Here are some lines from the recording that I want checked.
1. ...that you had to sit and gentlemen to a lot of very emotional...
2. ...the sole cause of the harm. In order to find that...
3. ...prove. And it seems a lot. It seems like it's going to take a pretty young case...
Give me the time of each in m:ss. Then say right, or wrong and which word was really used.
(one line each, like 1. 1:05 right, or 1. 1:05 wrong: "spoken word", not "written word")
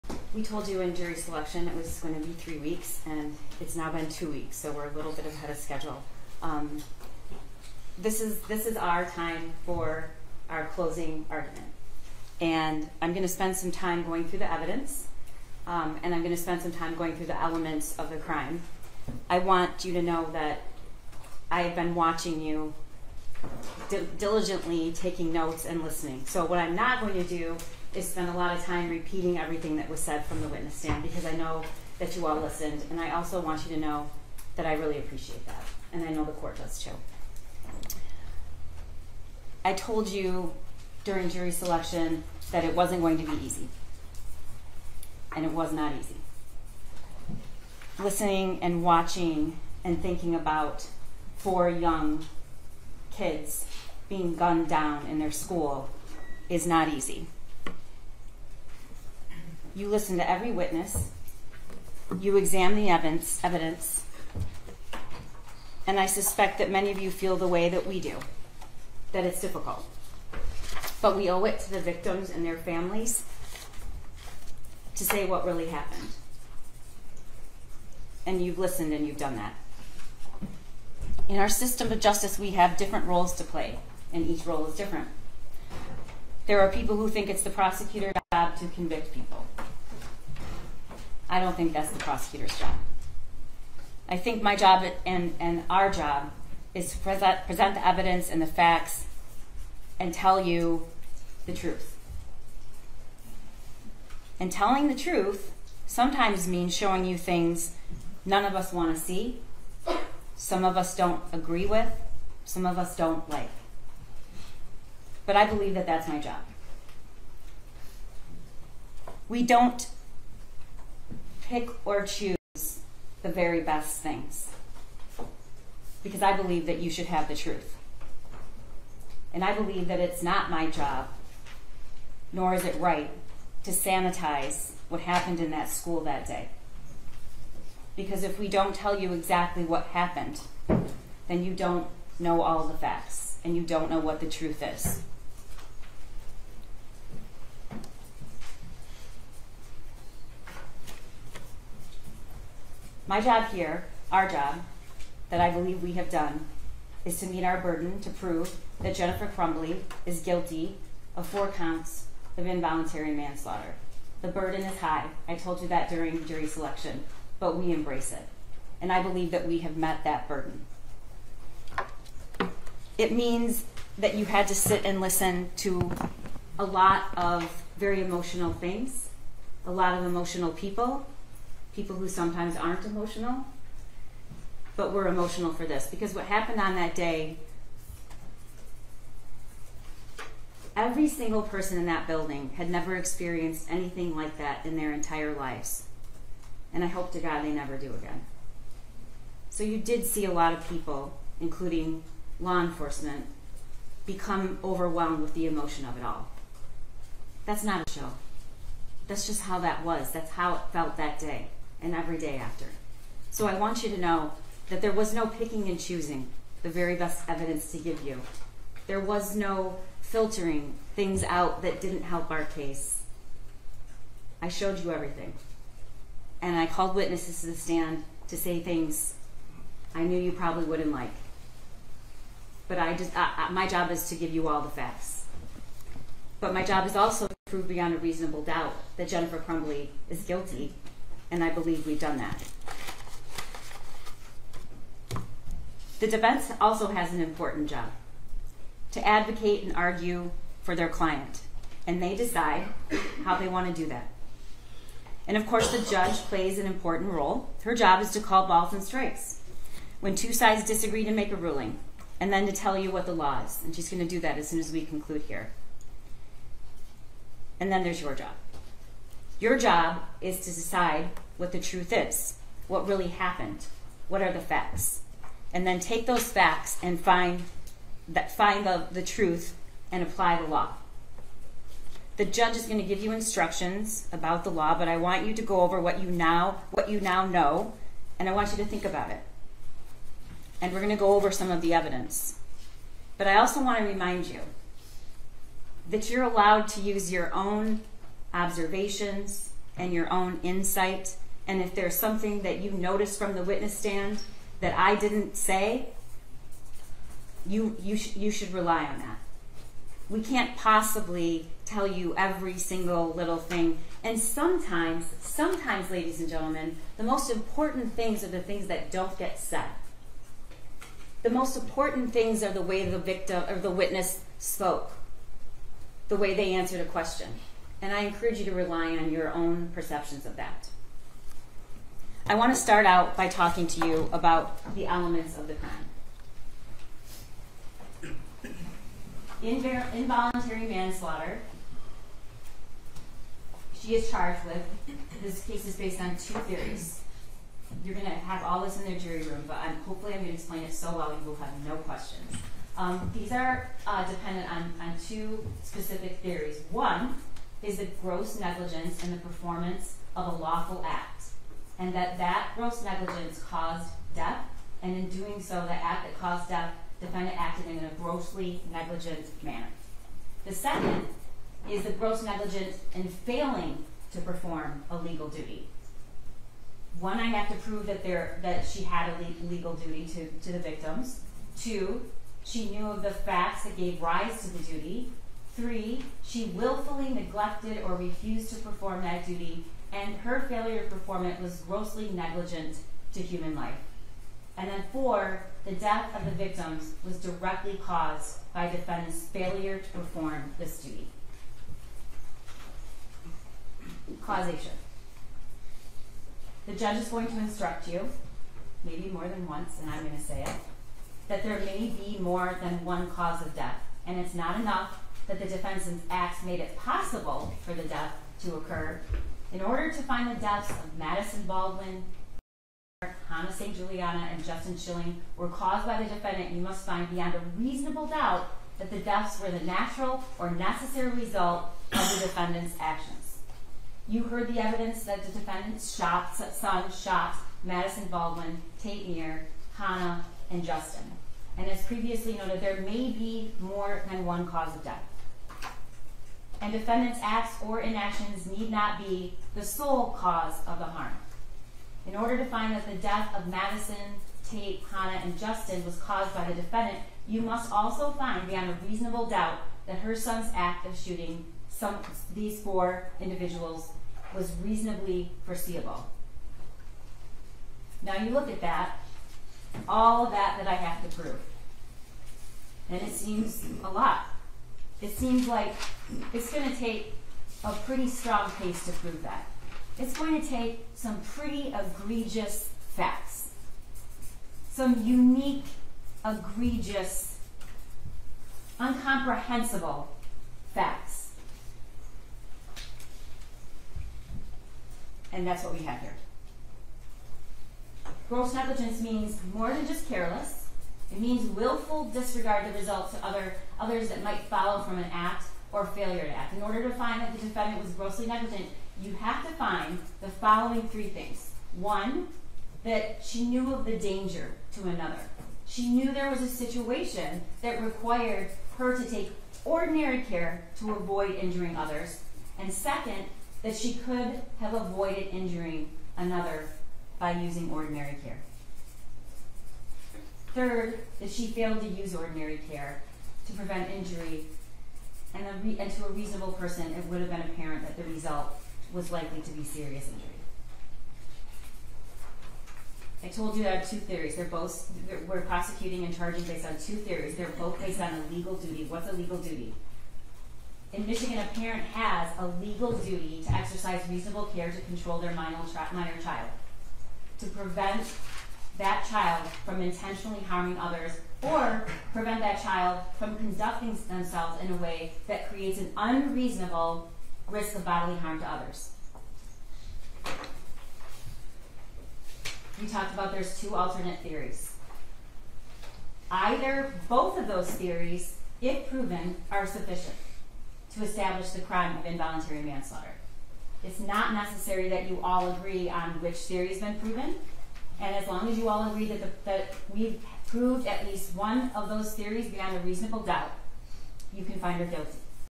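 1. 2:53 wrong: "listen", not "gentlemen"
2. 7:29 right
3. 7:51 wrong: "strong", not "young".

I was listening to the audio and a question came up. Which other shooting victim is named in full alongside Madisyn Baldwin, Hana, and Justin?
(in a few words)
Tate Neer.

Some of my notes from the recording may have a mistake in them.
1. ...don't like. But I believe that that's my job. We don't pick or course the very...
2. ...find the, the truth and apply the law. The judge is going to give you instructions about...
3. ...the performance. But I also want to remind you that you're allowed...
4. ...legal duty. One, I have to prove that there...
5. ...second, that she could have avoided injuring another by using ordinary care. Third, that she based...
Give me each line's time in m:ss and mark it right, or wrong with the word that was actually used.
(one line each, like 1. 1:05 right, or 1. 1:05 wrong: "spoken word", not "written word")
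1. 1:52 wrong: "choose", not "course"
2. 4:38 right
3. 4:51 wrong: "evidence", not "performance"
4. 6:14 right
5. 8:42 wrong: "failed", not "based".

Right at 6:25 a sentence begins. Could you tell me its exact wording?
Three, she willfully neglected or refused to perform that duty, and her failure to perform it was grossly negligent to human life.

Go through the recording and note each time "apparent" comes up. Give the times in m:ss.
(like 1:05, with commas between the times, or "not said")
8:57.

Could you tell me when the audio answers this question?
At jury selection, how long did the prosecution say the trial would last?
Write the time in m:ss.
0:02.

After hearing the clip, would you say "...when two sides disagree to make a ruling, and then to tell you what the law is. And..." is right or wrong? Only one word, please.
right.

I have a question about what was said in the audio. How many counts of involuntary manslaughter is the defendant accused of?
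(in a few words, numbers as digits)
4.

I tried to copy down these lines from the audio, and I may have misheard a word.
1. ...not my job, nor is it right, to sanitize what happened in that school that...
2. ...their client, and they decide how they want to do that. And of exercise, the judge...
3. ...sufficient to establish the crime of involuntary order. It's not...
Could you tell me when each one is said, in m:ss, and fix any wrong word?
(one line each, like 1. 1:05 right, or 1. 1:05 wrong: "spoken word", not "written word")
1. 2:10 right
2. 4:10 wrong: "course", not "exercise"
3. 9:39 wrong: "manslaughter", not "order".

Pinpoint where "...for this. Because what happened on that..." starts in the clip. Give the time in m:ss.
3:05.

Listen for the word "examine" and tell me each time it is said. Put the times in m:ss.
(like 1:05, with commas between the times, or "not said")
1:02.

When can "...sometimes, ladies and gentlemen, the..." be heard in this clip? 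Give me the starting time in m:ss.
5:15.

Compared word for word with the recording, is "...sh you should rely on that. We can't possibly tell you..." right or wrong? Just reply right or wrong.
right.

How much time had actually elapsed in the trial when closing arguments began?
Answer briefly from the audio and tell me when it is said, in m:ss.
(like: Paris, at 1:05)
2 weeks, at 0:04.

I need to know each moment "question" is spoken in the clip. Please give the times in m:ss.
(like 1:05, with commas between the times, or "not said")
5:26, 5:51.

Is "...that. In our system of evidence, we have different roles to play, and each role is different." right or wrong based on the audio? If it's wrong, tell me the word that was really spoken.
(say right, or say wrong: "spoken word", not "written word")
wrong: "justice", not "evidence".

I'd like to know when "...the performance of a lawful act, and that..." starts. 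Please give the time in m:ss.
5:59.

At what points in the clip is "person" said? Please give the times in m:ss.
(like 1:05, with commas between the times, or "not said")
3:11, 8:56.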